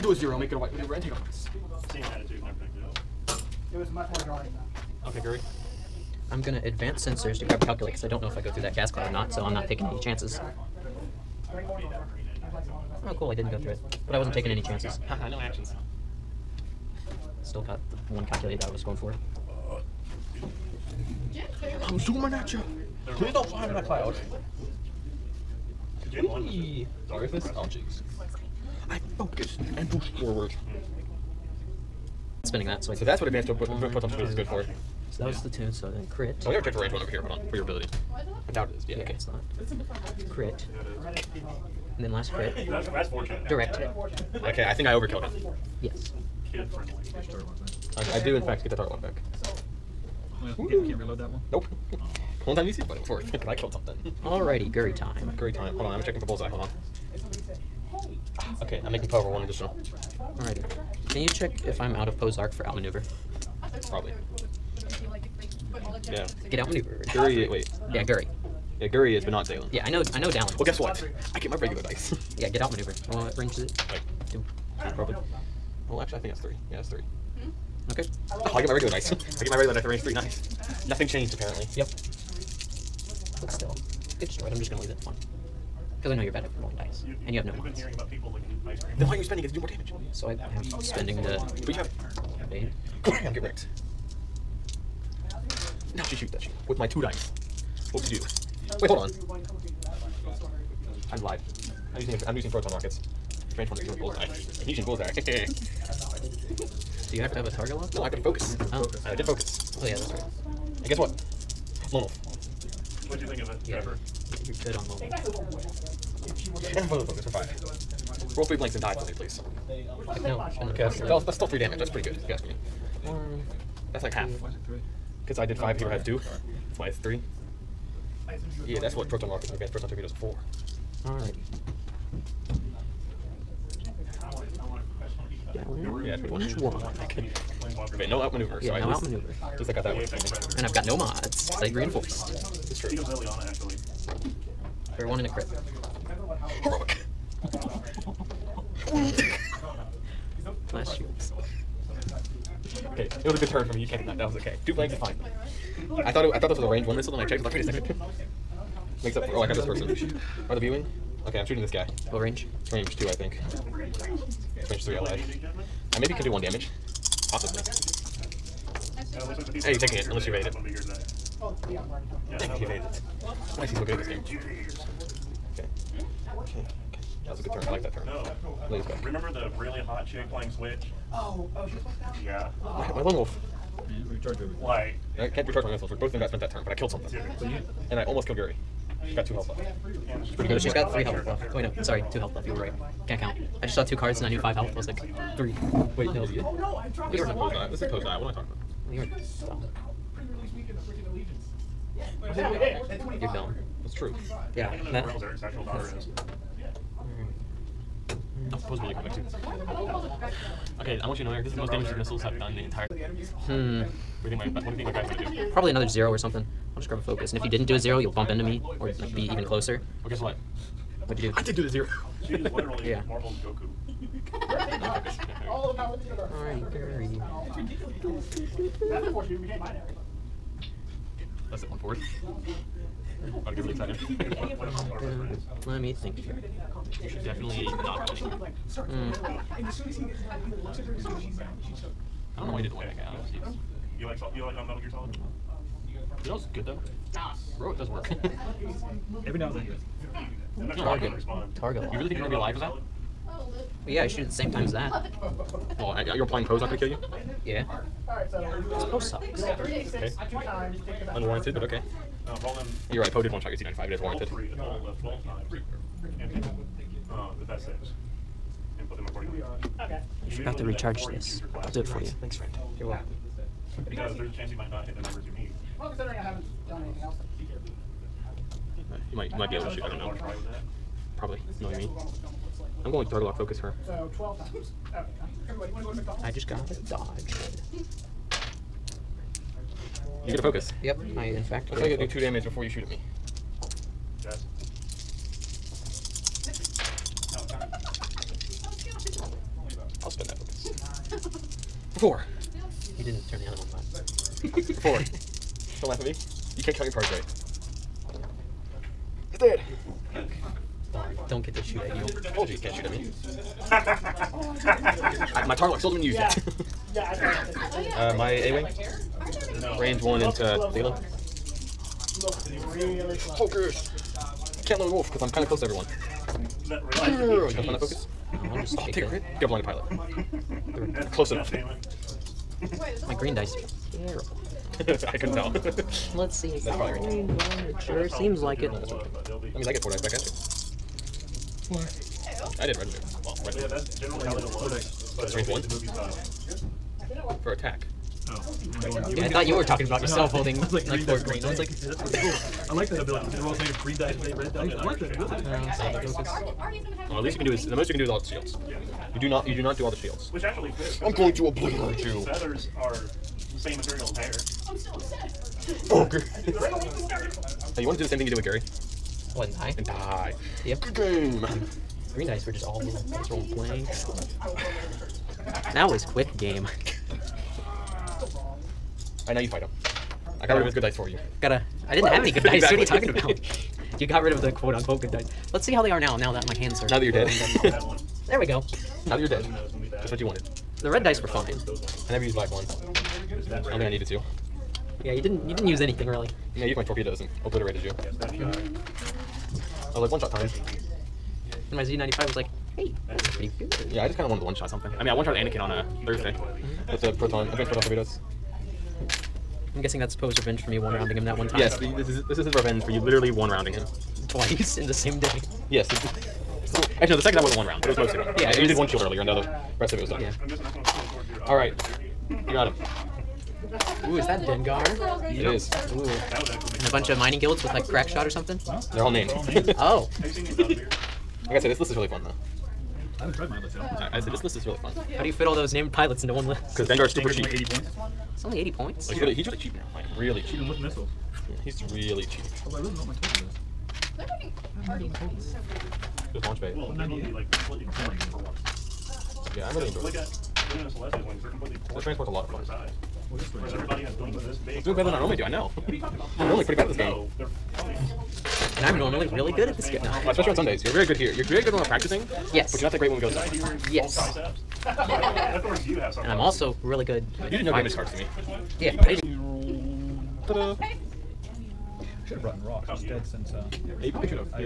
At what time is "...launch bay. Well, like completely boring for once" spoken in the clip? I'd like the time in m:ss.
7:26.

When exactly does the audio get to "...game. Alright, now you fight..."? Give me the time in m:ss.
6:16.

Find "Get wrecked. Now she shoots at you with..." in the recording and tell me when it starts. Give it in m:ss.
1:33.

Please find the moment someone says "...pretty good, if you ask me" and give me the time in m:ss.
2:01.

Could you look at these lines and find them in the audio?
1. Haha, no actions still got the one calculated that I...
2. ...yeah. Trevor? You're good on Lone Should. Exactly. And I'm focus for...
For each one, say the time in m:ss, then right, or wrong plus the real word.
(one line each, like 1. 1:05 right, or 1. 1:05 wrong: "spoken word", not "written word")
1. 0:15 right
2. 1:53 wrong: "Wolf", not "Should".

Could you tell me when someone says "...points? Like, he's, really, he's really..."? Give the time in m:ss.
7:18.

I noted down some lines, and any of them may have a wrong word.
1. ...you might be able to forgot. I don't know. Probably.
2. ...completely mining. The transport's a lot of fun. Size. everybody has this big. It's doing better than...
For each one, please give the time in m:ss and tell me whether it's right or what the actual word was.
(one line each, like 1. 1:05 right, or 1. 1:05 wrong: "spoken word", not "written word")
1. 4:39 wrong: "shoot", not "forgot"
2. 7:31 wrong: "boring", not "mining".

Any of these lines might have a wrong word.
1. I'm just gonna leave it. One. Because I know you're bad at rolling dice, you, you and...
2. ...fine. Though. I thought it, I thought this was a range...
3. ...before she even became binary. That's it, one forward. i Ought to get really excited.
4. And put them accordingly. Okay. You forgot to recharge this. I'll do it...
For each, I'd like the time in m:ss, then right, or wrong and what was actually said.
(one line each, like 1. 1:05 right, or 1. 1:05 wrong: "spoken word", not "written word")
1. 1:24 right
2. 2:34 right
3. 3:49 right
4. 4:28 right.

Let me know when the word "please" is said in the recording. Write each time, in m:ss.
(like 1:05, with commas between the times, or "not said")
0:23, 1:59.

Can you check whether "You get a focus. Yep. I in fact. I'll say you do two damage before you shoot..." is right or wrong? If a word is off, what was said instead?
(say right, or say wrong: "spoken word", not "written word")
right.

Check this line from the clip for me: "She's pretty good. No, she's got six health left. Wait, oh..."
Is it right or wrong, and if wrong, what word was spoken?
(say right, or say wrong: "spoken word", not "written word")
wrong: "three", not "six".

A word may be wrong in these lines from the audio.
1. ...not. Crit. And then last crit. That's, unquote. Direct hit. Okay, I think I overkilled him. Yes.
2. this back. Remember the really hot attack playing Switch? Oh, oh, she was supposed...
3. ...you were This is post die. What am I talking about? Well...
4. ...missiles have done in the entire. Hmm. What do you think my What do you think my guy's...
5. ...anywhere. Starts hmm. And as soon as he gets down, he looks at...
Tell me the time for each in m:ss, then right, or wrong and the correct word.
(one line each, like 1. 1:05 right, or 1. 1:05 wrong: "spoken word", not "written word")
1. 0:39 wrong: "fortunate", not "unquote"
2. 2:58 wrong: "chick", not "attack"
3. 3:17 right
4. 3:31 right
5. 3:58 right.